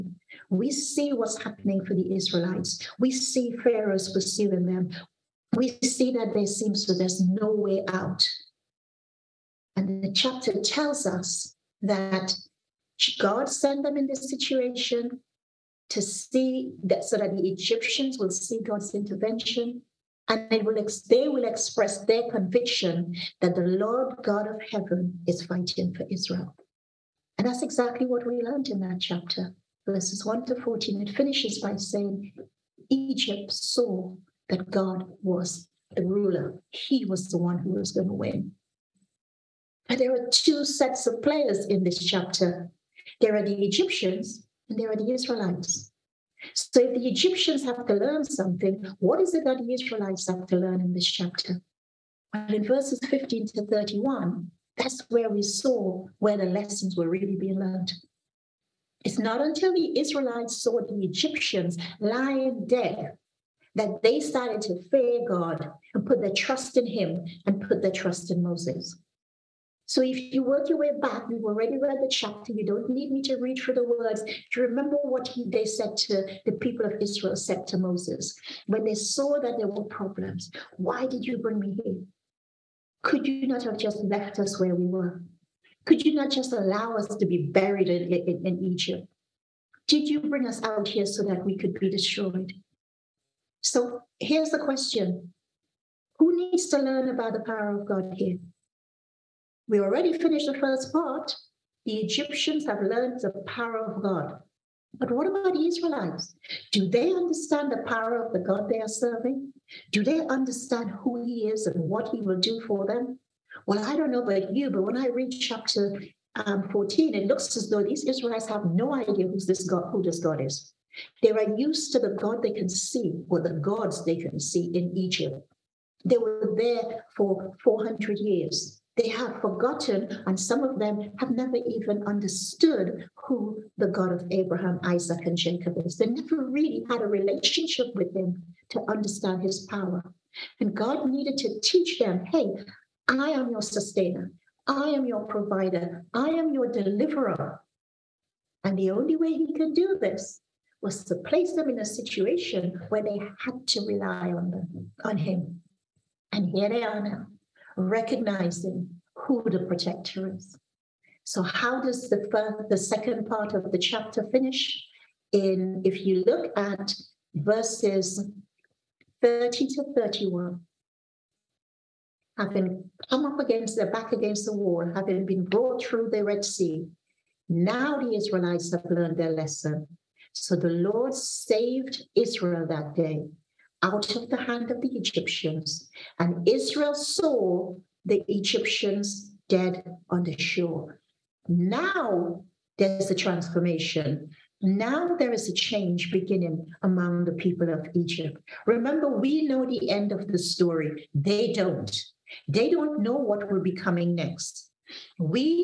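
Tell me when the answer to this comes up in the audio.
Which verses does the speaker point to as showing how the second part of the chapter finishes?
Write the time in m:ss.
2:47.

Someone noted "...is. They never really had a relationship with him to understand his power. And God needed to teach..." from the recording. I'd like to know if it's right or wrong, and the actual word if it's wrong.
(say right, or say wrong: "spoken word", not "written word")
right.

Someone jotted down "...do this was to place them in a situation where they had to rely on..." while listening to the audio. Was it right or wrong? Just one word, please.
right.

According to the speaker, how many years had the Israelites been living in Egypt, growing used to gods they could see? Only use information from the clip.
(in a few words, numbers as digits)
400 years.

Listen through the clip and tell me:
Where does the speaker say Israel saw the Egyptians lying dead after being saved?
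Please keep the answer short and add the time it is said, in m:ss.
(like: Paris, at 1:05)
On the shore, at 3:10.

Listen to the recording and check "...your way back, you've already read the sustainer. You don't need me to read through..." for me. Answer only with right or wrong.
wrong.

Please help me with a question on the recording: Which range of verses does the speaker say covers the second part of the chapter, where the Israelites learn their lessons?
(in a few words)
Verses 15 to 31.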